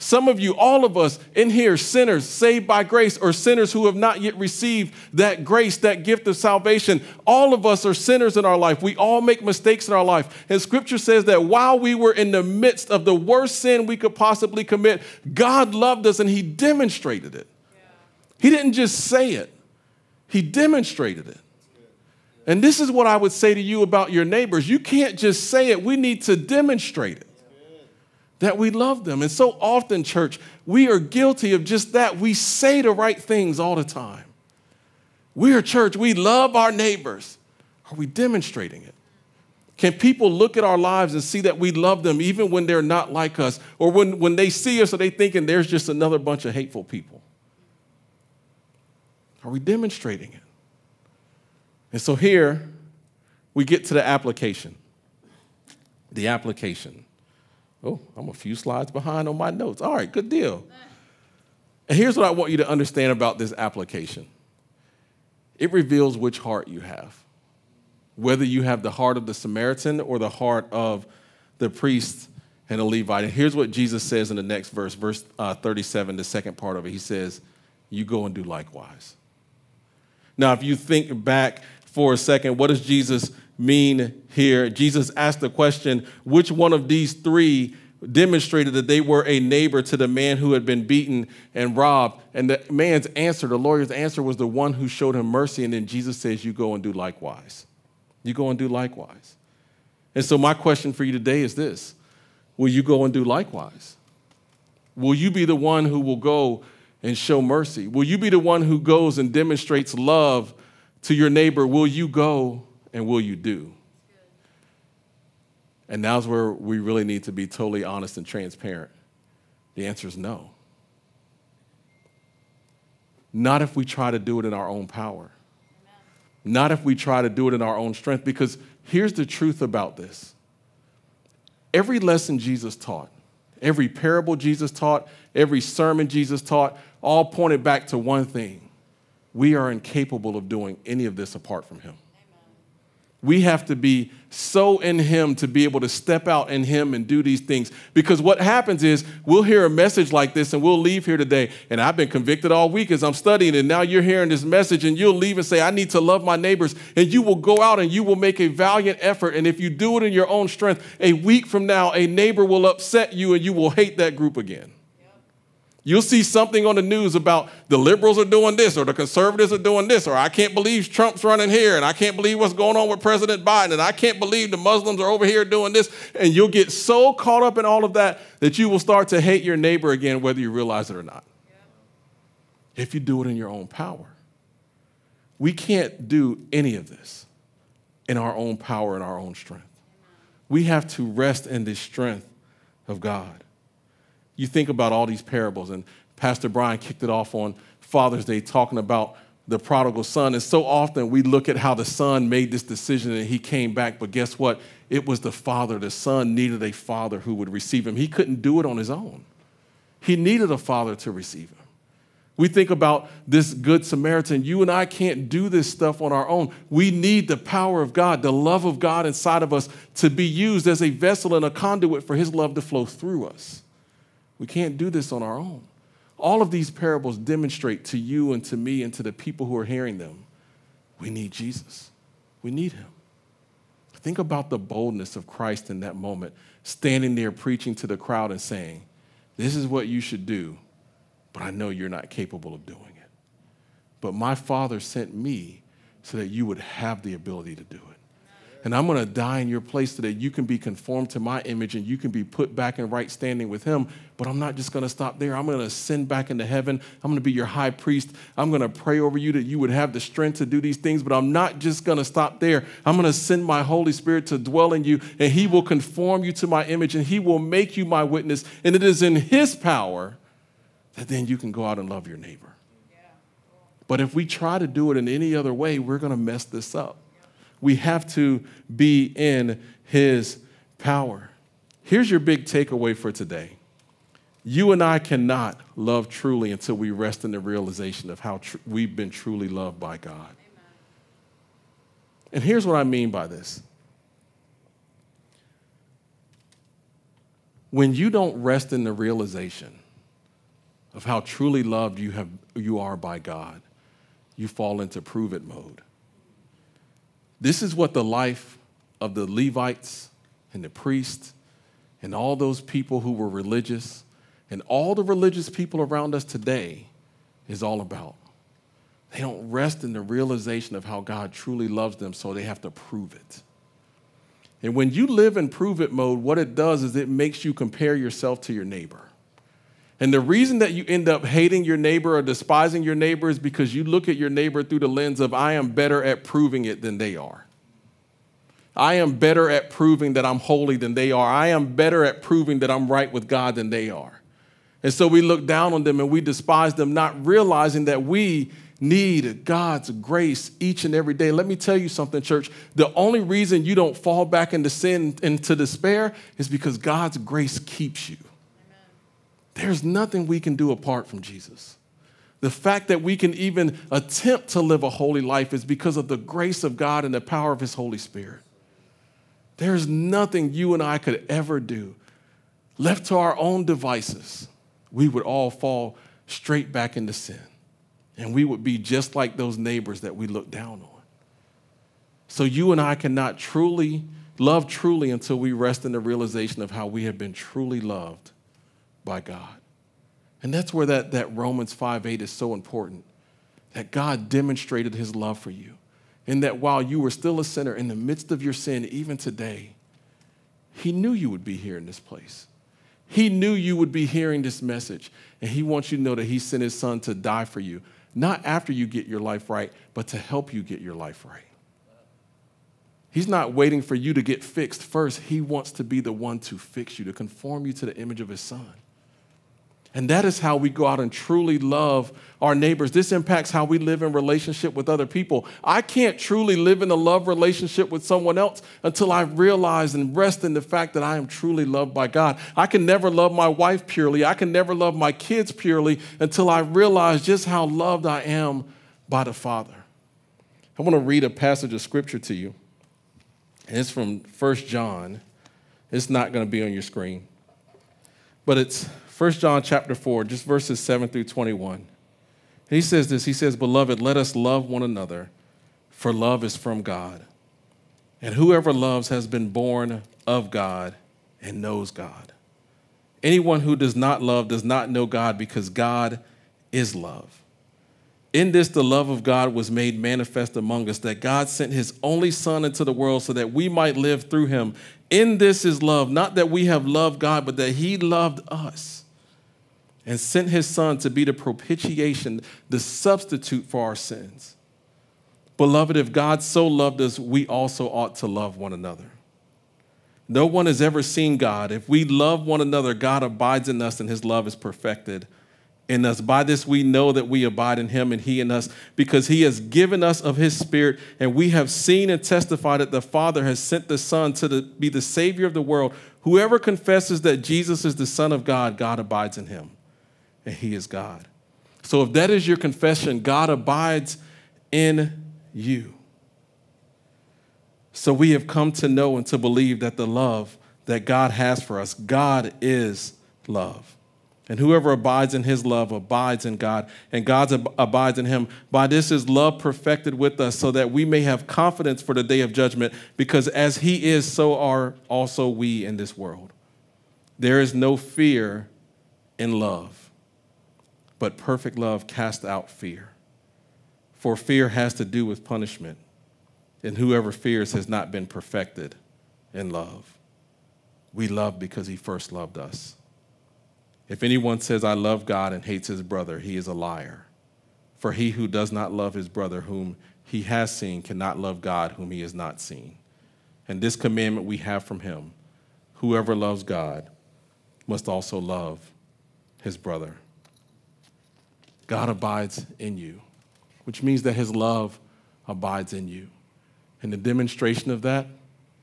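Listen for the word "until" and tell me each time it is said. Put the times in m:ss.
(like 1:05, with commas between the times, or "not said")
4:46, 6:25, 7:08, 7:16.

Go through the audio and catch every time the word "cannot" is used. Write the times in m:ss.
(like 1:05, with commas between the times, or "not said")
4:44, 6:22, 9:21.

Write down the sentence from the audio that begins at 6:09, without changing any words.
There's nothing you and I could ever do.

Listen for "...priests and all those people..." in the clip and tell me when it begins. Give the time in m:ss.
5:10.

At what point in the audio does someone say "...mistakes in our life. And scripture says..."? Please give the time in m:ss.
0:09.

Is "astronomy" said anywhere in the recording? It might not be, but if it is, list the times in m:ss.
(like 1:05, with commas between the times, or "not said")
not said.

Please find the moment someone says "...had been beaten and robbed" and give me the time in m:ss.
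1:30.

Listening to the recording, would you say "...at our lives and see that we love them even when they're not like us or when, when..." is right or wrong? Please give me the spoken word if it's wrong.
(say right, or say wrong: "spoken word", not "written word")
right.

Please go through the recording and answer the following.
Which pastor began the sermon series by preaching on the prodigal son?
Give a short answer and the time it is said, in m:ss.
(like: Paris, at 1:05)
Pastor Brian, at 3:16.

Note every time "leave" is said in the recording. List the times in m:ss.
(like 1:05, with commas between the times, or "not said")
2:30, 2:35.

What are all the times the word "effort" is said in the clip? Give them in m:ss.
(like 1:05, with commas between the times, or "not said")
2:39.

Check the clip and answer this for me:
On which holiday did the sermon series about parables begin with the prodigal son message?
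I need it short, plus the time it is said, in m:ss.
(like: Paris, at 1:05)
Father's Day, at 3:17.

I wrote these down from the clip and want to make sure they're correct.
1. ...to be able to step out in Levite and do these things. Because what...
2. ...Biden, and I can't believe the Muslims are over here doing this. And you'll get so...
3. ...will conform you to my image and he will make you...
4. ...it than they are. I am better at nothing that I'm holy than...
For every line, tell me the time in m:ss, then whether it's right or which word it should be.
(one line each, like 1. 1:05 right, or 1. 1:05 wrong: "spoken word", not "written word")
1. 2:25 wrong: "Him", not "Levite"
2. 2:53 right
3. 4:25 right
4. 5:36 wrong: "proving", not "nothing".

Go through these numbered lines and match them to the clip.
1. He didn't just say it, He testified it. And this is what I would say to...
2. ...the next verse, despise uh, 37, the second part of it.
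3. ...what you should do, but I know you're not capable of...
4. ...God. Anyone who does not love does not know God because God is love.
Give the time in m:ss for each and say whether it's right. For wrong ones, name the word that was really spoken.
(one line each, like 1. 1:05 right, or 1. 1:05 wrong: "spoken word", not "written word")
1. 0:18 wrong: "demonstrated", not "testified"
2. 1:14 wrong: "verse", not "despise"
3. 3:59 right
4. 7:41 right.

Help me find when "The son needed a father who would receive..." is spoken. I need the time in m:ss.
3:25.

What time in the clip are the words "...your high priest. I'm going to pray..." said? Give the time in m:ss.
4:17.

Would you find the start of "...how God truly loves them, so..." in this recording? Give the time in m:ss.
5:20.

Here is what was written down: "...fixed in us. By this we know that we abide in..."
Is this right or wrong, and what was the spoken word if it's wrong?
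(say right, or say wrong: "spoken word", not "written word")
wrong: "perfected", not "fixed".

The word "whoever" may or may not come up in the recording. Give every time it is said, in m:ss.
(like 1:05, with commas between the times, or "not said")
7:38, 8:26, 8:44, 9:06, 9:25.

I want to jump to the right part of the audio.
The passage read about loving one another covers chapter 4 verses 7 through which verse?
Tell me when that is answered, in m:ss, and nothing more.
7:31.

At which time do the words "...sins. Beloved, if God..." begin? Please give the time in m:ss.
8:03.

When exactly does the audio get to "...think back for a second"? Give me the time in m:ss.
1:20.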